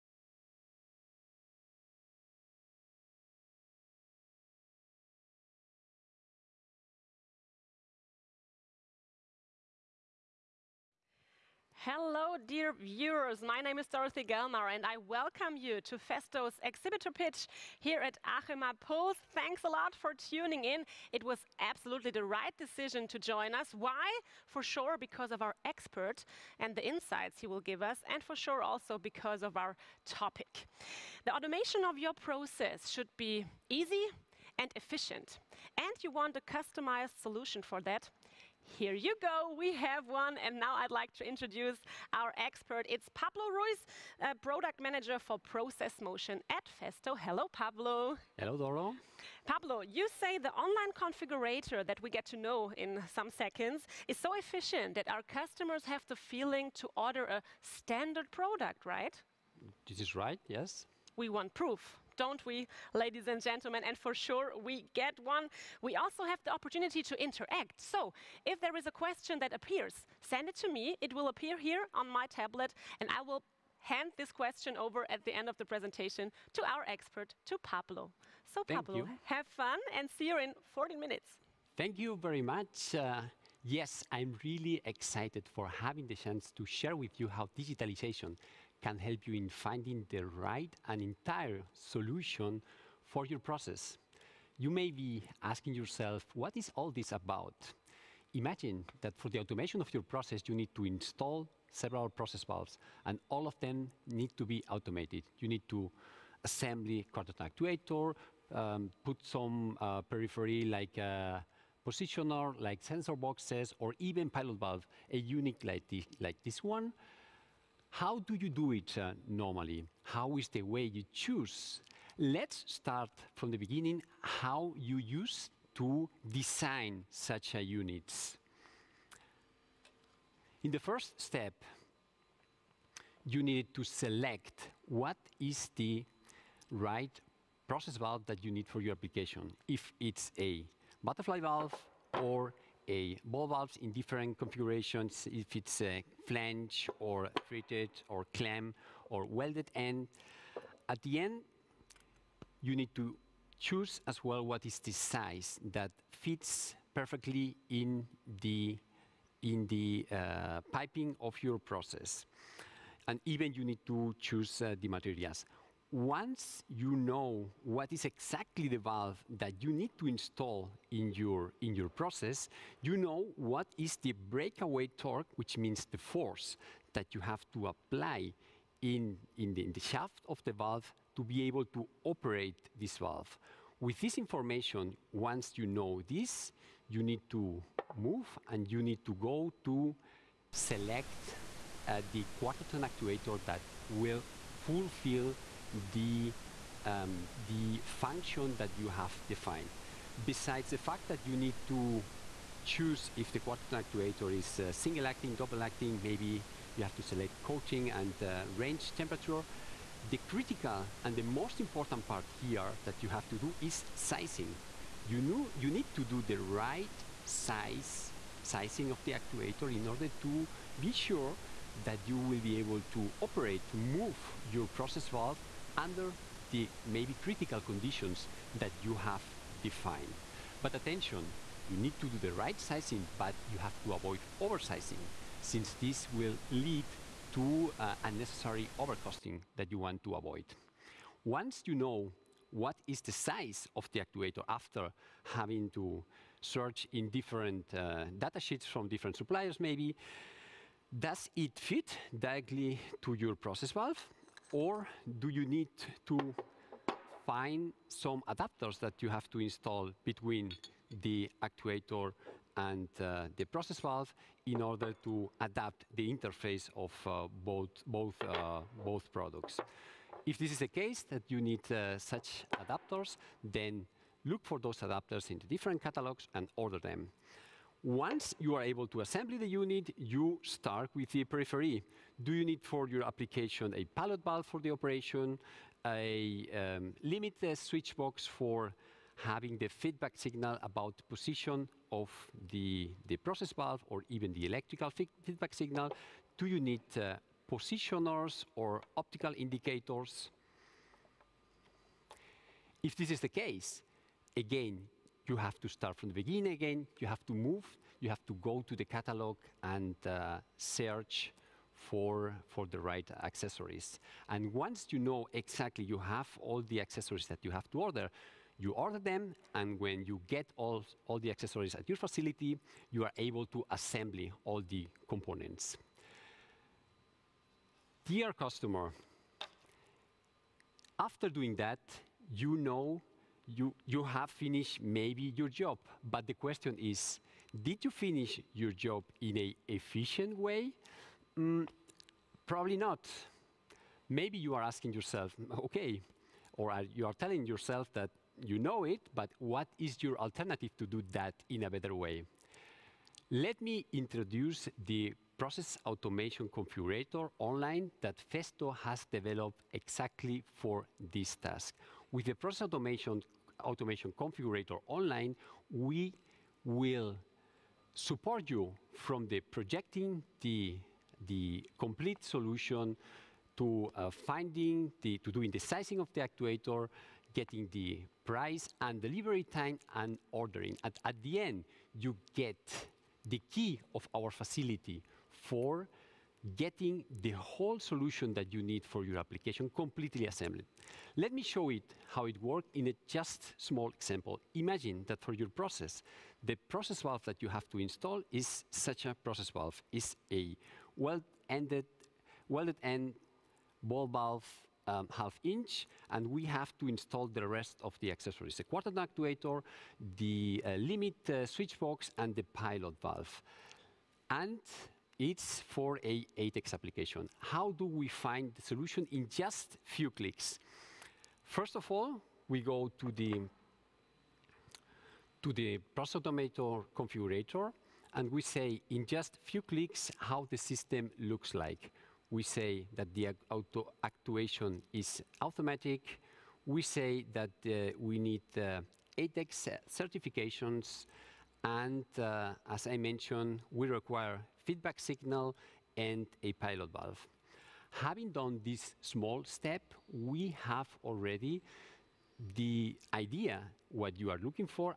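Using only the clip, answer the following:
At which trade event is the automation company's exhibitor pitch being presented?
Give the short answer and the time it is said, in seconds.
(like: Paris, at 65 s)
Achema Pulse, at 18 s.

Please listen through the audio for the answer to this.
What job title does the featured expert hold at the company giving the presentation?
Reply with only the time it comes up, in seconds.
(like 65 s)
44 s.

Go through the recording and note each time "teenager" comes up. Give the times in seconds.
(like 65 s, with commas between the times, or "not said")
not said.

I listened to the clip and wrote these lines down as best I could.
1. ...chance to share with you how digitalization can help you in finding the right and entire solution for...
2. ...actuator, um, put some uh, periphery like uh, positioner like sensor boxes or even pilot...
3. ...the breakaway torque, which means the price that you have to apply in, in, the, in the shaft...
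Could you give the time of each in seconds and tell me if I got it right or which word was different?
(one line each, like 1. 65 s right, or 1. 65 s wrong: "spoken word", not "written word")
1. 86 s right
2. 107 s right
3. 173 s wrong: "force", not "price".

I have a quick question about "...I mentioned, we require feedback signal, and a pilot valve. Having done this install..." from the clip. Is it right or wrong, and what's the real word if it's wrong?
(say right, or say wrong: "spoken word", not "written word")
wrong: "small", not "install".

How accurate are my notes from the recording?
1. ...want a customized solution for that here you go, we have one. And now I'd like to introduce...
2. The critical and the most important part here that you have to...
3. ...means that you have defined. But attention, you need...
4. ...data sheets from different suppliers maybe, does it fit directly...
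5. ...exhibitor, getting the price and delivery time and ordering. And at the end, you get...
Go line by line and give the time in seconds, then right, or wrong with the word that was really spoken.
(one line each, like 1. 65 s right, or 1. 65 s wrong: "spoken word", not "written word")
1. 36 s right
2. 210 s right
3. 227 s wrong: "conditions", not "means"
4. 248 s right
5. 376 s wrong: "actuator", not "exhibitor".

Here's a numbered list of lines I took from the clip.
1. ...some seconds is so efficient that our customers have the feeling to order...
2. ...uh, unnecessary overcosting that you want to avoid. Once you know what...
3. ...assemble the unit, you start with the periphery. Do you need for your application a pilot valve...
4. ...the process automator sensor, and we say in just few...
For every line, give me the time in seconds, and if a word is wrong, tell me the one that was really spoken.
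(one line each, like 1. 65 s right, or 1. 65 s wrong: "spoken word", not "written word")
1. 53 s right
2. 237 s right
3. 278 s right
4. 425 s wrong: "configurator", not "sensor".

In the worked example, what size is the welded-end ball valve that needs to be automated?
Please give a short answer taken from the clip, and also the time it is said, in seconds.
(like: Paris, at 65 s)
half inch, at 405 s.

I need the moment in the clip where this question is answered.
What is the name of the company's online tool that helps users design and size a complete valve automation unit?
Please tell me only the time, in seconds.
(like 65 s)
362 s.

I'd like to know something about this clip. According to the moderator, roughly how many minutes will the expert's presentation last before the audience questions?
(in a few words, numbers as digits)
14.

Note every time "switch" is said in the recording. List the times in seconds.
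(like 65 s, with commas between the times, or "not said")
287 s, 411 s.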